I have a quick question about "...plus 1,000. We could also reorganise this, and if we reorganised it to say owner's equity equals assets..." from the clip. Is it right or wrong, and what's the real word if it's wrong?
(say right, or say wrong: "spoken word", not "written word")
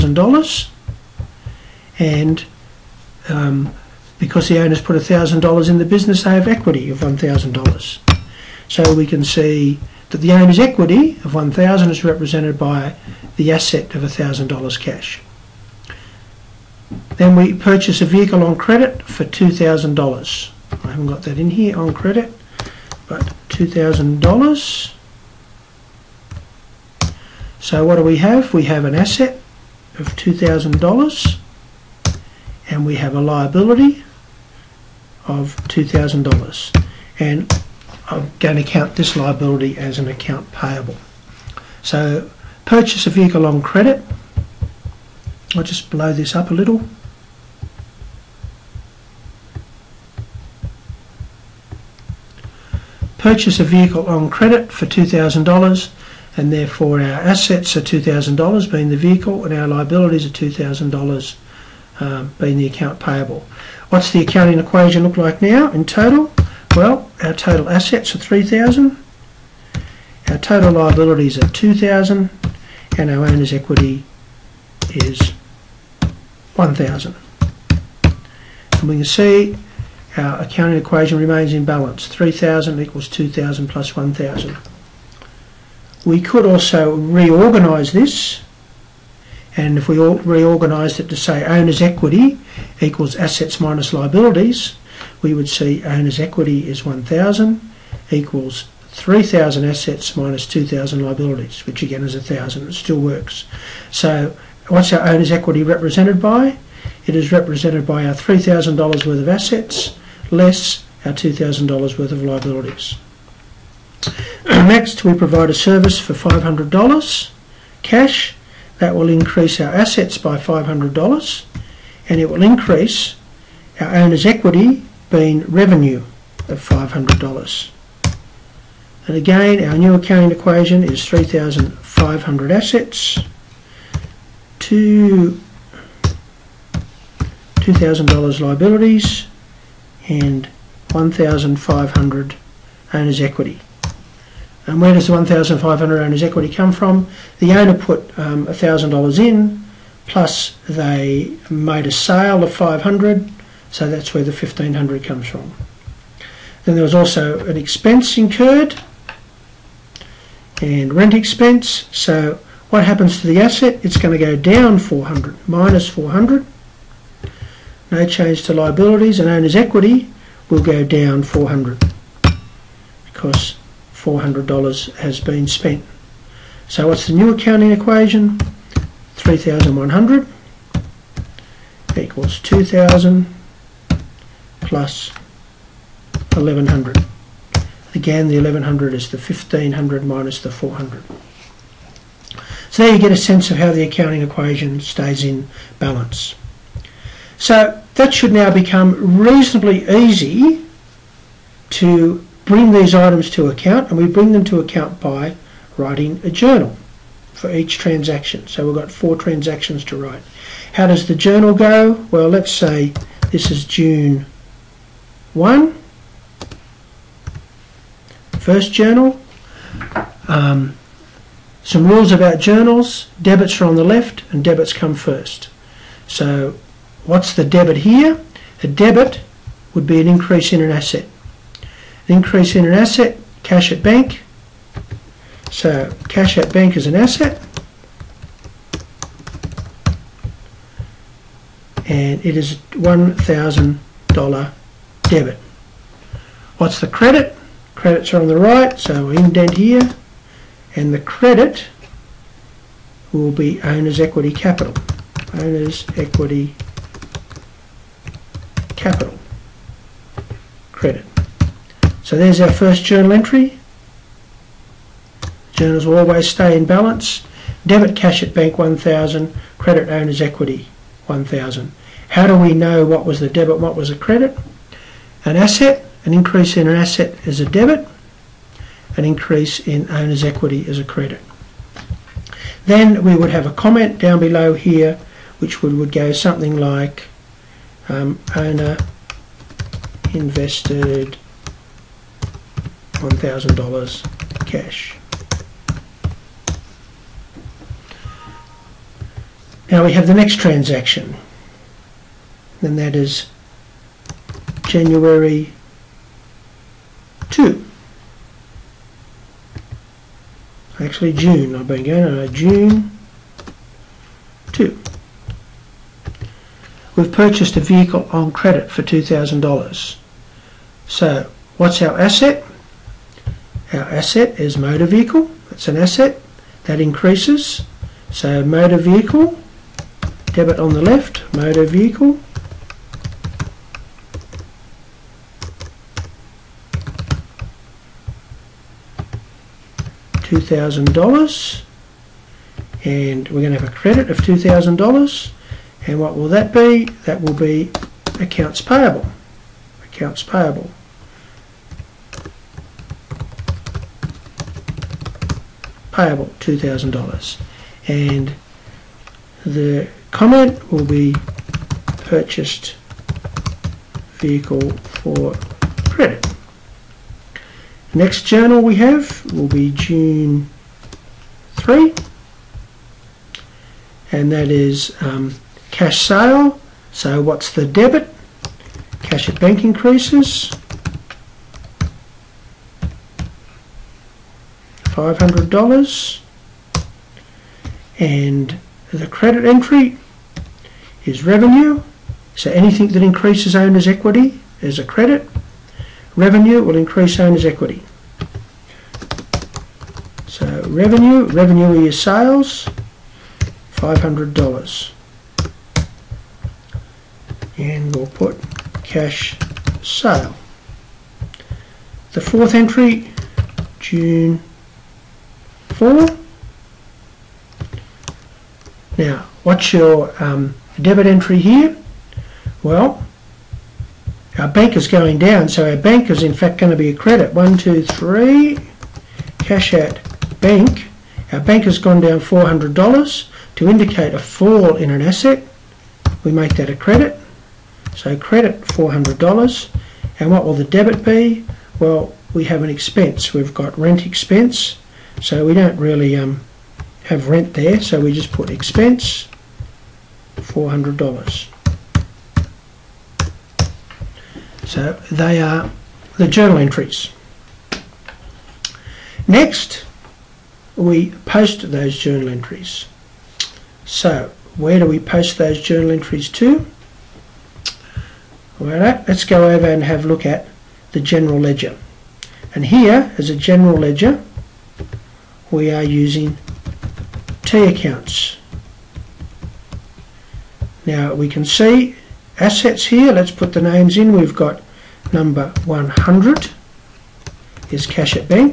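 right.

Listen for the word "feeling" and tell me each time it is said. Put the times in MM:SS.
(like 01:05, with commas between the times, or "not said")
not said.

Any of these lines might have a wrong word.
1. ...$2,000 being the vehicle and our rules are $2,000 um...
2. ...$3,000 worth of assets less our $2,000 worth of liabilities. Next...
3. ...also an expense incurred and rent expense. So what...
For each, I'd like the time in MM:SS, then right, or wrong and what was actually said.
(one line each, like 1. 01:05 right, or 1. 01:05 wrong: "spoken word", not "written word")
1. 00:57 wrong: "liabilities", not "rules"
2. 01:48 right
3. 02:36 right.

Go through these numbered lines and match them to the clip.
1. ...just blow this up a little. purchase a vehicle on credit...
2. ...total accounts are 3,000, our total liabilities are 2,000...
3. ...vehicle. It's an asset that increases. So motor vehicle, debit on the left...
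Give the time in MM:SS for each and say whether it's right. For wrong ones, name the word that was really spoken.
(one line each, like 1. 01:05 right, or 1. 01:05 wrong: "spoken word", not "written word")
1. 00:45 right
2. 01:07 wrong: "assets", not "accounts"
3. 05:24 right.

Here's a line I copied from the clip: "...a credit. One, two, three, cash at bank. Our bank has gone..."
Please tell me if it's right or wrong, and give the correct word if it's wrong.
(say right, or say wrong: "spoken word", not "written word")
right.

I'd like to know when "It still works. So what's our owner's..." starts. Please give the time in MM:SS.
01:42.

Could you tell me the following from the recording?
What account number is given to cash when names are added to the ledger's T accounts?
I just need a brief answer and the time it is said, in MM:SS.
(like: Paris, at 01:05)
100, at 08:05.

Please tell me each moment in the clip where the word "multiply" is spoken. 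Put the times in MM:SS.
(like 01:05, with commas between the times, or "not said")
not said.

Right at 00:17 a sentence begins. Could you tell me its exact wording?
Then we purchase a vehicle on credit for $2,000.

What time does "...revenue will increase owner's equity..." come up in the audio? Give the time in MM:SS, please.
06:36.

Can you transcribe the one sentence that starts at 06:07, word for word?
Next journal we have will be June 3 and that is um, Cash sale, so what's the debit?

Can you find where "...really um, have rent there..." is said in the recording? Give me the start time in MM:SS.
07:25.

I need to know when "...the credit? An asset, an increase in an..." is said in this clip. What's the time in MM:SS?
04:33.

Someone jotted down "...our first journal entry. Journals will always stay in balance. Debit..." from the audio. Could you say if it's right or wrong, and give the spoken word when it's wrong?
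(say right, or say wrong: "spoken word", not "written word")
right.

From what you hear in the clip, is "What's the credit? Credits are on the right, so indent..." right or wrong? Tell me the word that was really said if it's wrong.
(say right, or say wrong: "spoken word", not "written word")
right.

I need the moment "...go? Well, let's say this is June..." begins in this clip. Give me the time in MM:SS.
03:31.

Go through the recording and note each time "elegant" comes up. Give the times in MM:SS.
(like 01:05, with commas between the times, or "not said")
not said.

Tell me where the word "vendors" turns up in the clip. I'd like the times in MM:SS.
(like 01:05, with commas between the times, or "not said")
not said.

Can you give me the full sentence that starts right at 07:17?
So credit $400 and what will the debit be?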